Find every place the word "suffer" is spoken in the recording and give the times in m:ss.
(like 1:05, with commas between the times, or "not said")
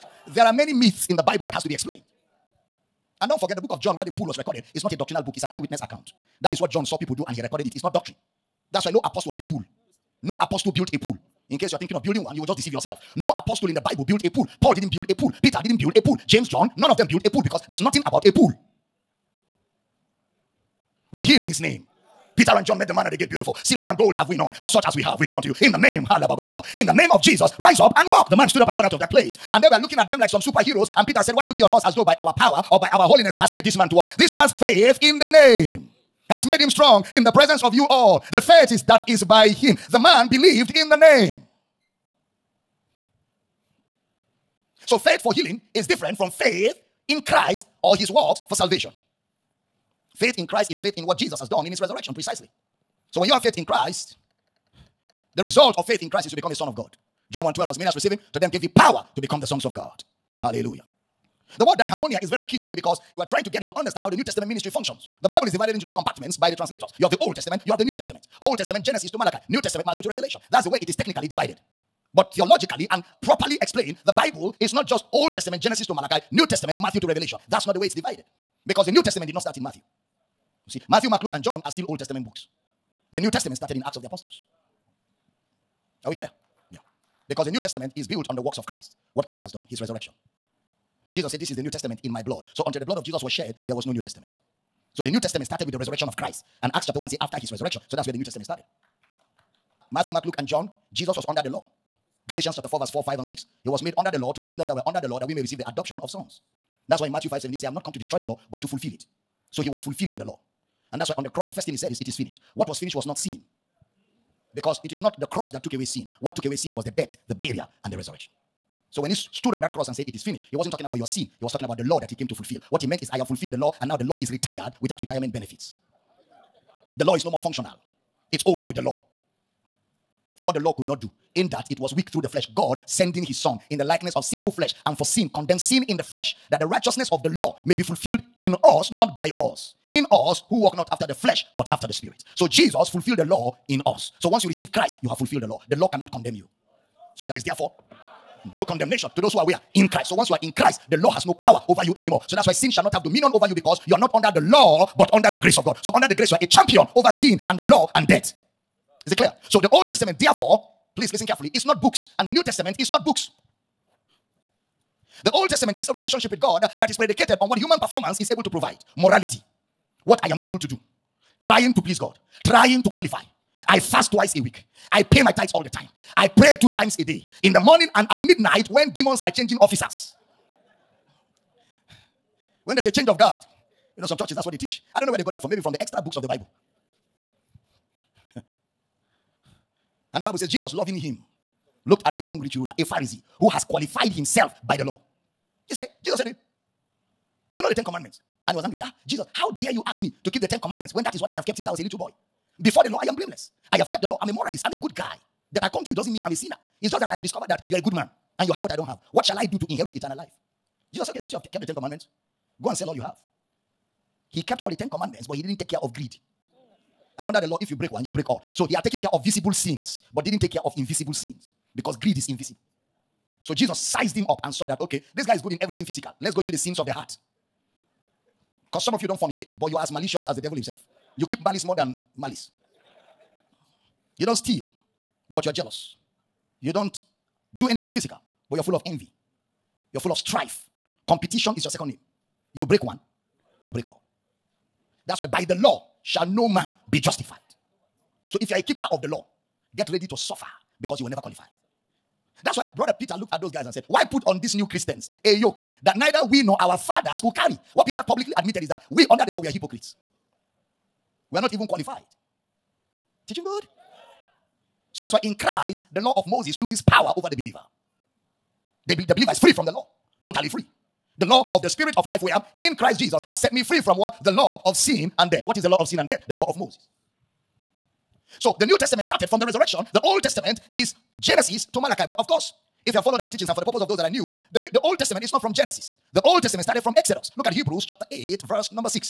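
4:10.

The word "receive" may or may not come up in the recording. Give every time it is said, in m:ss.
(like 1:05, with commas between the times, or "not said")
0:57, 1:45, 2:24.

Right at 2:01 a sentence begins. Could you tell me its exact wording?
He was talking about the law that he came to fulfill.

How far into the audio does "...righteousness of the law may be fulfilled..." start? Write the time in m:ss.
2:16.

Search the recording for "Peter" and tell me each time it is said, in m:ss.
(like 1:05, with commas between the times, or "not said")
0:15, 0:22, 0:31, 4:12, 4:17.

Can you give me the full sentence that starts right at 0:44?
So faith for healing is different from faith in Christ or his works for salvation.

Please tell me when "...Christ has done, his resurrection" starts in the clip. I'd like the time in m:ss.
1:29.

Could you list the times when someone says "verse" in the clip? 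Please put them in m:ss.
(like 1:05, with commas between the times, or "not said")
1:42, 4:48.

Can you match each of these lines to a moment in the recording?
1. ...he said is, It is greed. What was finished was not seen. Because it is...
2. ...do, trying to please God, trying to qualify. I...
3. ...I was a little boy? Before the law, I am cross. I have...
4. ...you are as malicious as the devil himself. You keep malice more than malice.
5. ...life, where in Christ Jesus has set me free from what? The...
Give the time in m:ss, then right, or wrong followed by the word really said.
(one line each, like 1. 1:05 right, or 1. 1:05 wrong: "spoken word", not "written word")
1. 1:51 wrong: "finished", not "greed"
2. 2:50 right
3. 3:21 wrong: "blameless", not "cross"
4. 3:49 right
5. 4:32 right.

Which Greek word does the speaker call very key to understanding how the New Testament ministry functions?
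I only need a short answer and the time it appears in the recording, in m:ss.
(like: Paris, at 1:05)
diermeneuo, at 1:01.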